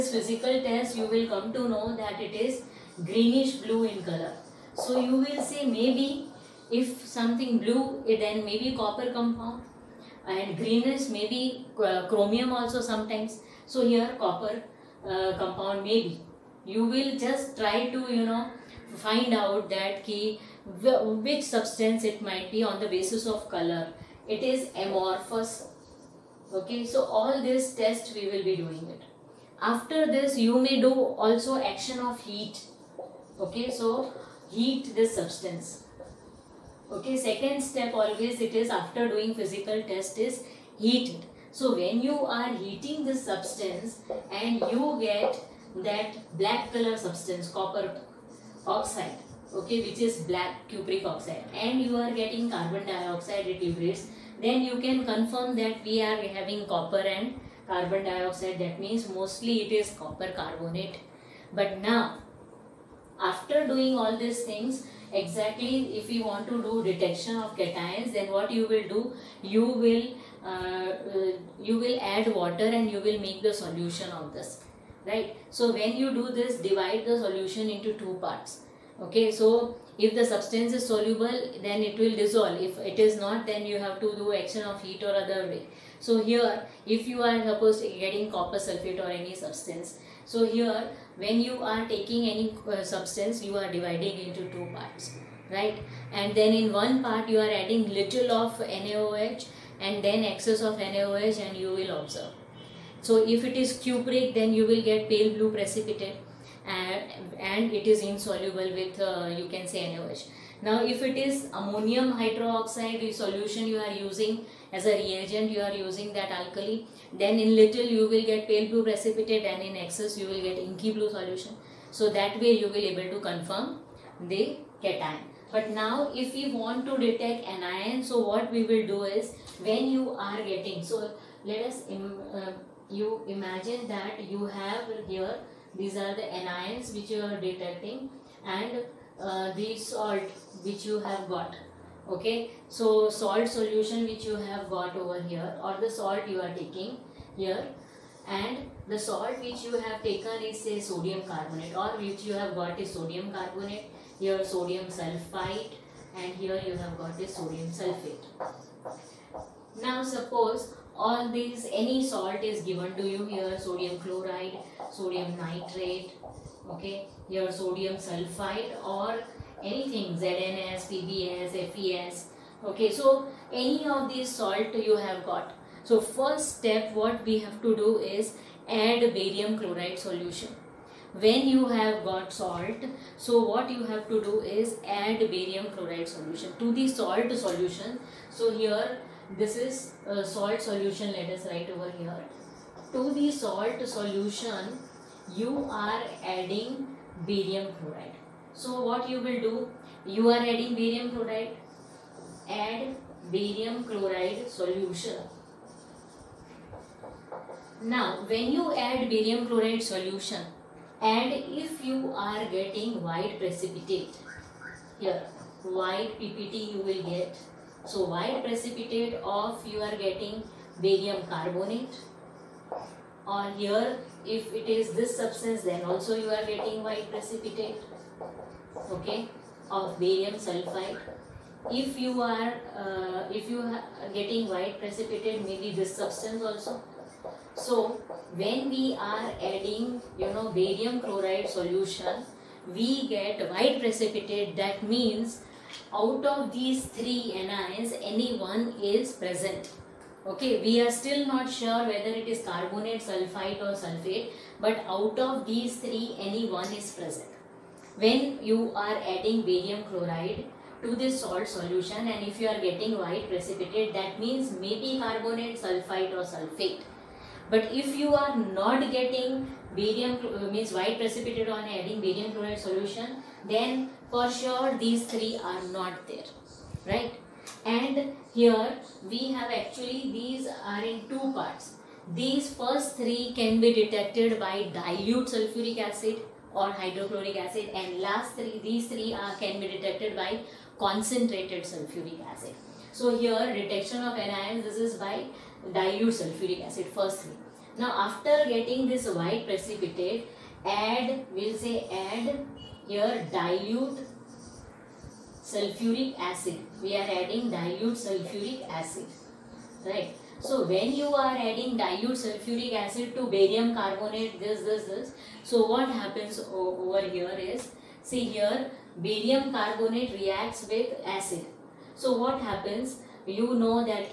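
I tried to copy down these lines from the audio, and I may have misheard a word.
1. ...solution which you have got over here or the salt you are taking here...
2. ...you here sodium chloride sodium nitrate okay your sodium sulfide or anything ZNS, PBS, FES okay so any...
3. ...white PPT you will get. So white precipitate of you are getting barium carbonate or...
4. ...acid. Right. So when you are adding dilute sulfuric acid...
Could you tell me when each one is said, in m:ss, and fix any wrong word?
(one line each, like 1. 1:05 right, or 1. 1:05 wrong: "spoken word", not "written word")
1. 2:23 right
2. 2:43 right
3. 3:35 right
4. 5:08 right.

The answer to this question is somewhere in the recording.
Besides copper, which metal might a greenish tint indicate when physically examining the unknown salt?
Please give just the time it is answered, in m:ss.
0:12.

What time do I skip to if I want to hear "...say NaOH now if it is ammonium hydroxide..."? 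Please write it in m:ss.
1:49.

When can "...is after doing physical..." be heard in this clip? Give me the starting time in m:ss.
0:38.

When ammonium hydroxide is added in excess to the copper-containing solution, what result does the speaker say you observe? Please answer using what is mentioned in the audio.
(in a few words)
Inky blue solution.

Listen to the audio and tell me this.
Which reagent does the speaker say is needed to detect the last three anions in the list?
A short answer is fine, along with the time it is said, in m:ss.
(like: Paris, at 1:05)
Concentrated sulfuric acid, at 4:50.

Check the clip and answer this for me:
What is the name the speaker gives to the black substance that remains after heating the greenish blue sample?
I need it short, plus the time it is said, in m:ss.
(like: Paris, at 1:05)
Cupric oxide, at 0:50.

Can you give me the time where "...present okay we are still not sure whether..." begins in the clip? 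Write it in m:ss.
4:09.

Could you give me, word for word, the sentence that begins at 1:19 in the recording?
Okay, so if the substance is soluble, then it will dissolve.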